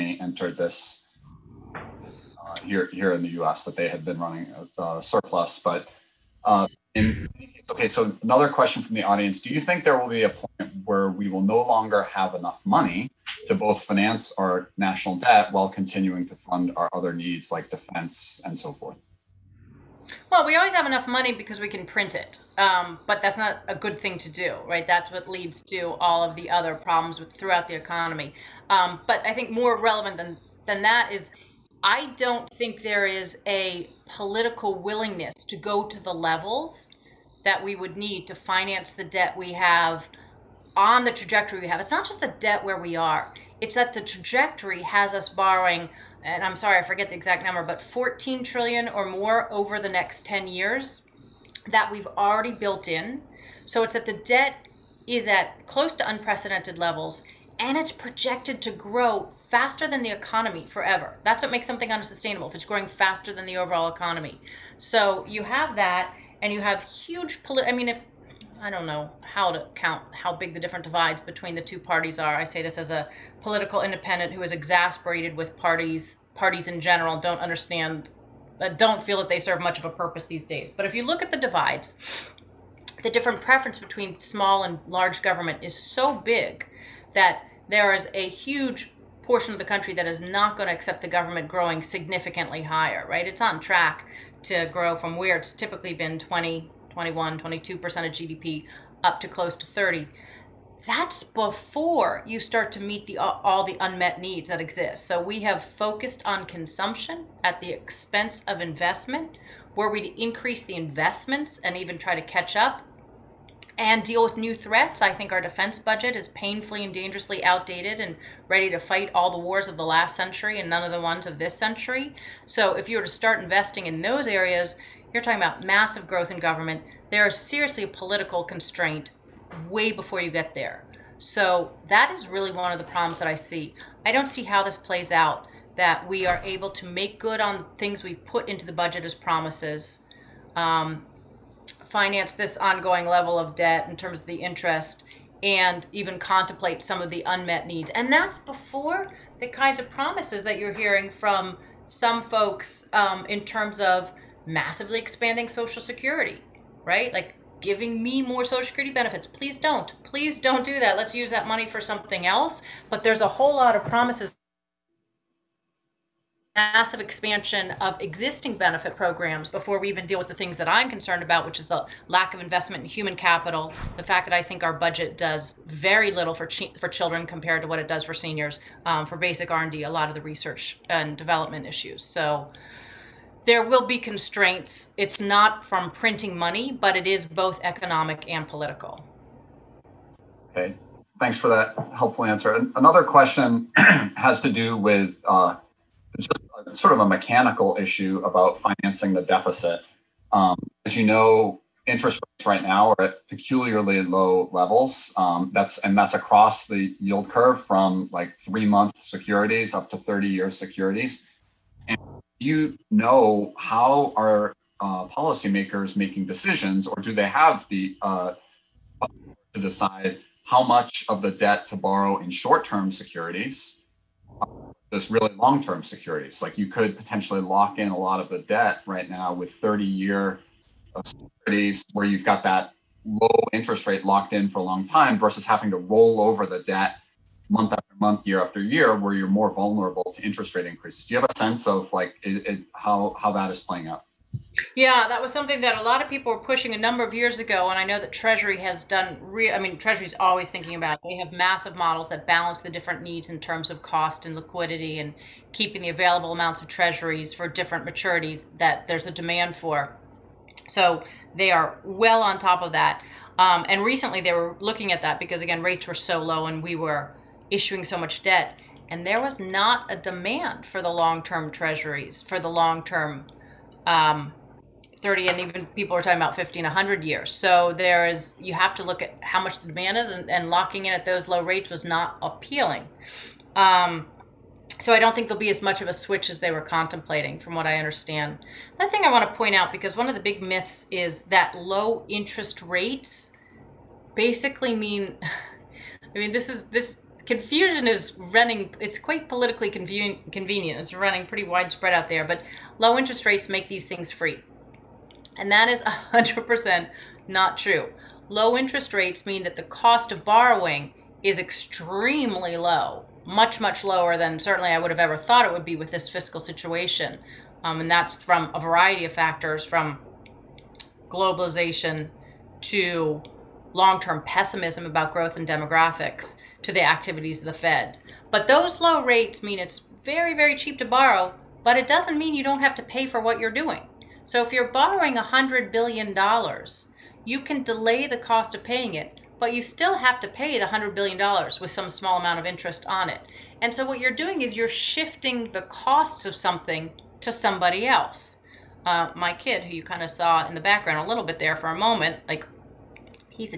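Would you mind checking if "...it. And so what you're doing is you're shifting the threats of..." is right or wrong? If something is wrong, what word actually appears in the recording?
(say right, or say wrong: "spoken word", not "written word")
wrong: "costs", not "threats".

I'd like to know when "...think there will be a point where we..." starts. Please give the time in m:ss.
0:09.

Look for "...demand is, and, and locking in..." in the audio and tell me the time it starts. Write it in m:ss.
4:39.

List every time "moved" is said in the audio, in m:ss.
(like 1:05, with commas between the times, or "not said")
not said.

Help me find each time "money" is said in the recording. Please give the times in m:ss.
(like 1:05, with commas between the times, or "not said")
0:12, 0:21, 2:41, 3:06.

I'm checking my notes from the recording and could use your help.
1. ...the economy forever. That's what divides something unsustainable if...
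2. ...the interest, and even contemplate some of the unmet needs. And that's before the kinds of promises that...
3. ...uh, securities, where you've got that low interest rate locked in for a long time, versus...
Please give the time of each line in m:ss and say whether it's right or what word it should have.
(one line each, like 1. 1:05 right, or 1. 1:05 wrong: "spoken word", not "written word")
1. 1:00 wrong: "makes", not "divides"
2. 2:24 right
3. 3:50 right.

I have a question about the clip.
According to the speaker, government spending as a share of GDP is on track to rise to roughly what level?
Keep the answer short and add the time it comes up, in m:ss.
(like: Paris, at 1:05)
close to 30%, at 1:39.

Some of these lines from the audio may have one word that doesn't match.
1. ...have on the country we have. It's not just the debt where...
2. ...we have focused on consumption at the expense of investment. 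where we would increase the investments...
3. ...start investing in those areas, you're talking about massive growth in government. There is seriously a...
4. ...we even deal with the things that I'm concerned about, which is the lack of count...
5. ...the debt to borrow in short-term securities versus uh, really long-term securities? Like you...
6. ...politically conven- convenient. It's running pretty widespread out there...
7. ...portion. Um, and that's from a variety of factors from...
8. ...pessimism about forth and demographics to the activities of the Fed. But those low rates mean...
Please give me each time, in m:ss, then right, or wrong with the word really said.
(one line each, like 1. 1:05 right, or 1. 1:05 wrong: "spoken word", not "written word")
1. 0:39 wrong: "trajectory", not "country"
2. 1:45 right
3. 2:03 right
4. 2:49 wrong: "investment", not "count"
5. 3:41 right
6. 4:59 right
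7. 5:16 wrong: "situation", not "portion"
8. 5:24 wrong: "growth", not "forth".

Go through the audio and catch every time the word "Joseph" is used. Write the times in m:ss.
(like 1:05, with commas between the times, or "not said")
not said.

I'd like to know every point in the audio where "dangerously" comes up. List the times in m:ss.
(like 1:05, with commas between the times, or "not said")
1:56.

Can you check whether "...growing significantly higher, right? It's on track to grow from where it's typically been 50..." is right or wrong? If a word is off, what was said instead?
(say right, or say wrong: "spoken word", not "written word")
wrong: "20", not "50".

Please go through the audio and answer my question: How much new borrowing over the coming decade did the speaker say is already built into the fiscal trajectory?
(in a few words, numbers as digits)
14 trillion.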